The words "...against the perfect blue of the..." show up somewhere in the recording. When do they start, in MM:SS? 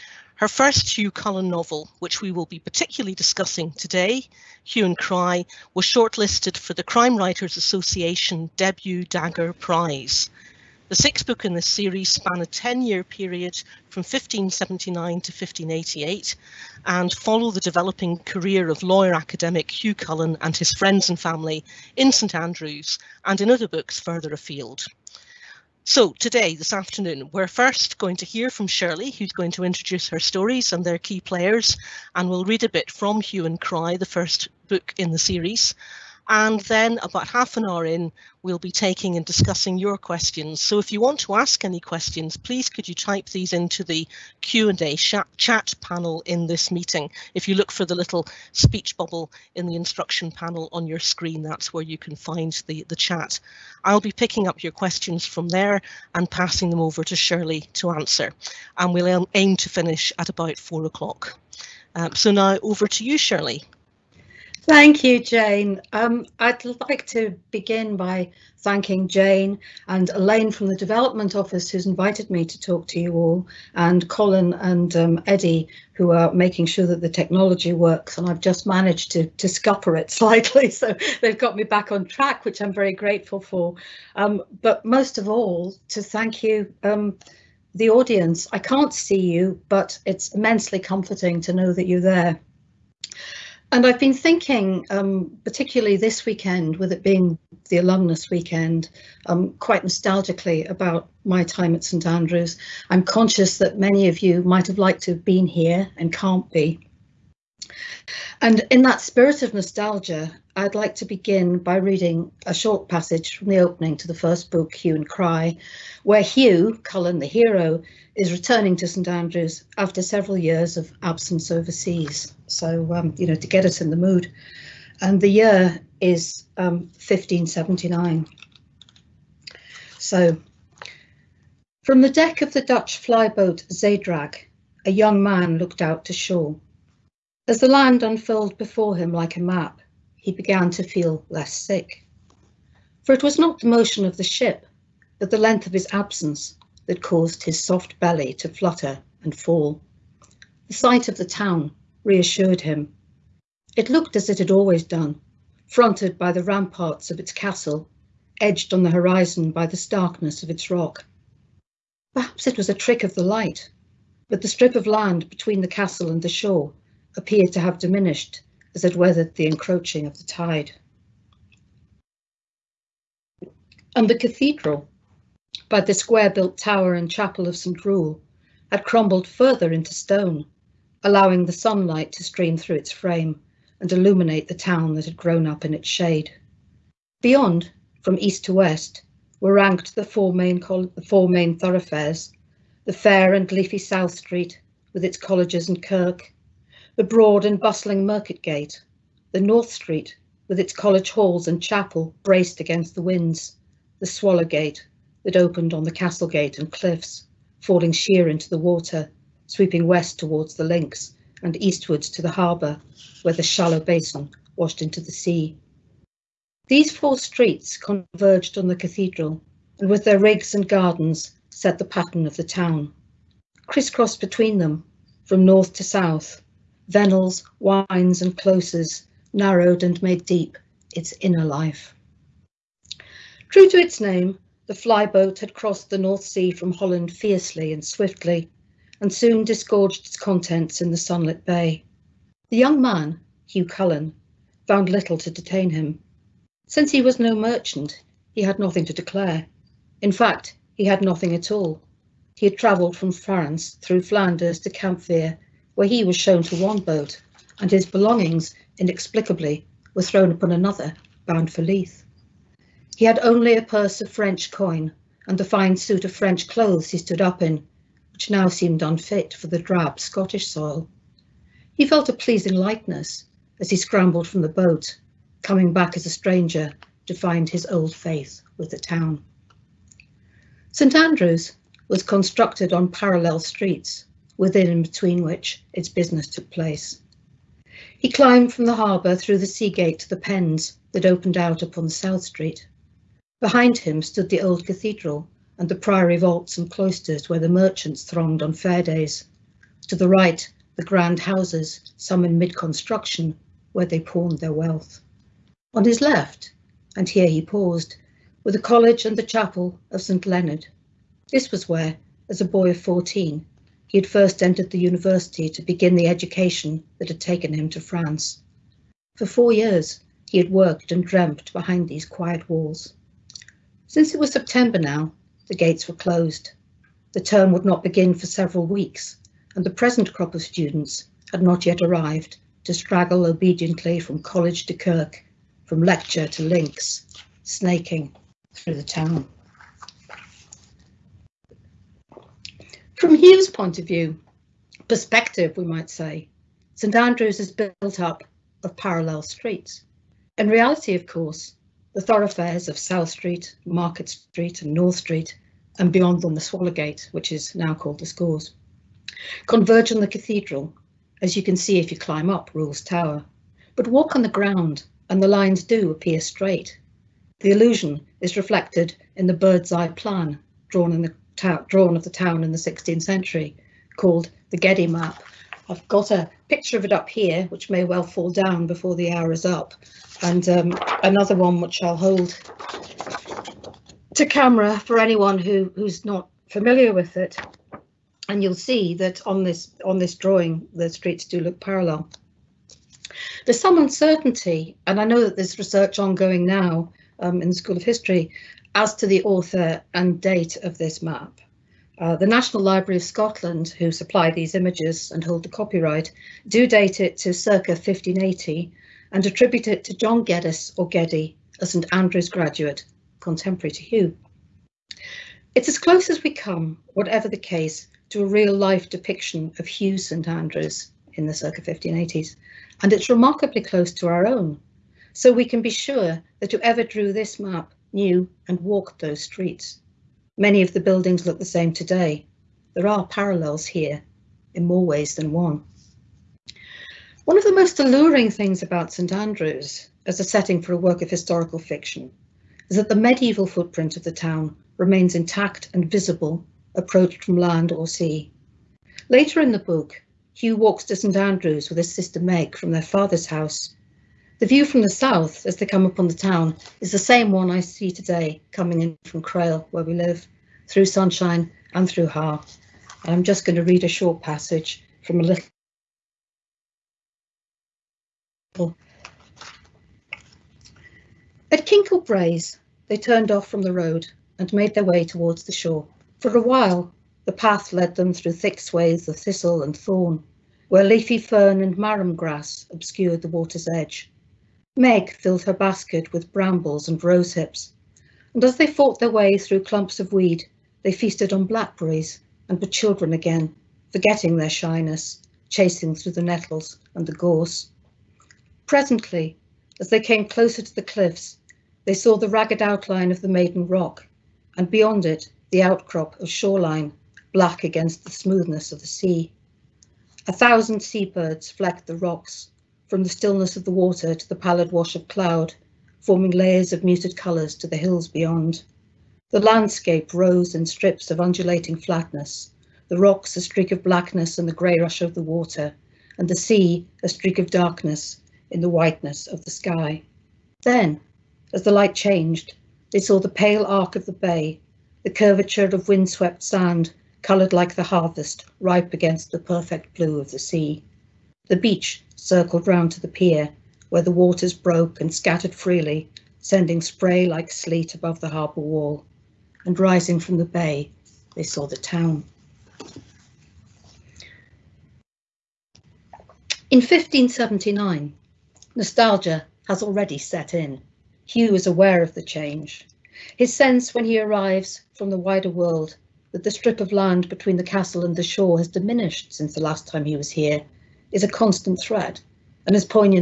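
08:58.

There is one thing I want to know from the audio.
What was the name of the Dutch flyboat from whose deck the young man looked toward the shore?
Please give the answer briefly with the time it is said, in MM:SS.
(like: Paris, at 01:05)
Zeedrag, at 02:13.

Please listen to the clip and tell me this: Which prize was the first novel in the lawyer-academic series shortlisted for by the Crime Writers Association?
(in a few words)
Debut Dagger Prize.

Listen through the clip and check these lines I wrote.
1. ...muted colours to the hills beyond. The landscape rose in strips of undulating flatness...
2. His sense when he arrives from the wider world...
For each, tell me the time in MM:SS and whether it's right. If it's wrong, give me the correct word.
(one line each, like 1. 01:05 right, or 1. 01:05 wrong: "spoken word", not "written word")
1. 08:36 right
2. 09:23 right.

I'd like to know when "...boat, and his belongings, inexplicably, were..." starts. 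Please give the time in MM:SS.
04:16.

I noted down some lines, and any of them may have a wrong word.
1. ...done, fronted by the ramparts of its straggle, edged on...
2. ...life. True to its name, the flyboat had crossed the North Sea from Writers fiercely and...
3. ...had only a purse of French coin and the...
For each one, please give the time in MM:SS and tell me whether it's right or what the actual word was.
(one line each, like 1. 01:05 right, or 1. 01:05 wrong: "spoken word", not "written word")
1. 02:34 wrong: "castle", not "straggle"
2. 03:51 wrong: "Holland", not "Writers"
3. 04:23 right.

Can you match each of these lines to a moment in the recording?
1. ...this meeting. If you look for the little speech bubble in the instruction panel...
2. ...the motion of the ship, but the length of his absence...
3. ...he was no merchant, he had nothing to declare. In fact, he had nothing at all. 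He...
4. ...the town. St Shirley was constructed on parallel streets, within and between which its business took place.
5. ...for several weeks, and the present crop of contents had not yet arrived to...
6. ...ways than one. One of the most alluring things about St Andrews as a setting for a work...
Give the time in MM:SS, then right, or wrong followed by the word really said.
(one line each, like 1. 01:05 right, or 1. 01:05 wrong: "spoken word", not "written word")
1. 00:46 right
2. 02:23 right
3. 04:06 right
4. 04:38 wrong: "Andrews", not "Shirley"
5. 05:28 wrong: "students", not "contents"
6. 07:14 right.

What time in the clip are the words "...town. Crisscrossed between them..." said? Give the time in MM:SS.
03:42.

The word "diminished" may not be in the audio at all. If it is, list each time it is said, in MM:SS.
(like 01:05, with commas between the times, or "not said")
02:47, 09:28.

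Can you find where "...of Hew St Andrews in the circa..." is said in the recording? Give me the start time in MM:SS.
06:59.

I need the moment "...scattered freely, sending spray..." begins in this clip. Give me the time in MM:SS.
09:05.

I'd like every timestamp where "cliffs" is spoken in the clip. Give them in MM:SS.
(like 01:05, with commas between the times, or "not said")
03:26, 08:20.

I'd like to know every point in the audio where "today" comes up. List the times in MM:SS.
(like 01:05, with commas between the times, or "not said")
00:03, 00:26, 07:11, 07:37.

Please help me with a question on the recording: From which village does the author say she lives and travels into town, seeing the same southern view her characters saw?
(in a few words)
Crail.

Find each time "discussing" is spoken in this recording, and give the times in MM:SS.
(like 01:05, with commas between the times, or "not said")
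00:03, 00:39.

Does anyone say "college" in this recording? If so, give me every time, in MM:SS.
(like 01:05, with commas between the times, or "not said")
03:15, 03:20, 05:08, 05:34.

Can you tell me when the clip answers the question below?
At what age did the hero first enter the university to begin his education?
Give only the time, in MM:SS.
05:12.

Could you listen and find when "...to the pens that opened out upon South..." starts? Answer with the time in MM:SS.
04:49.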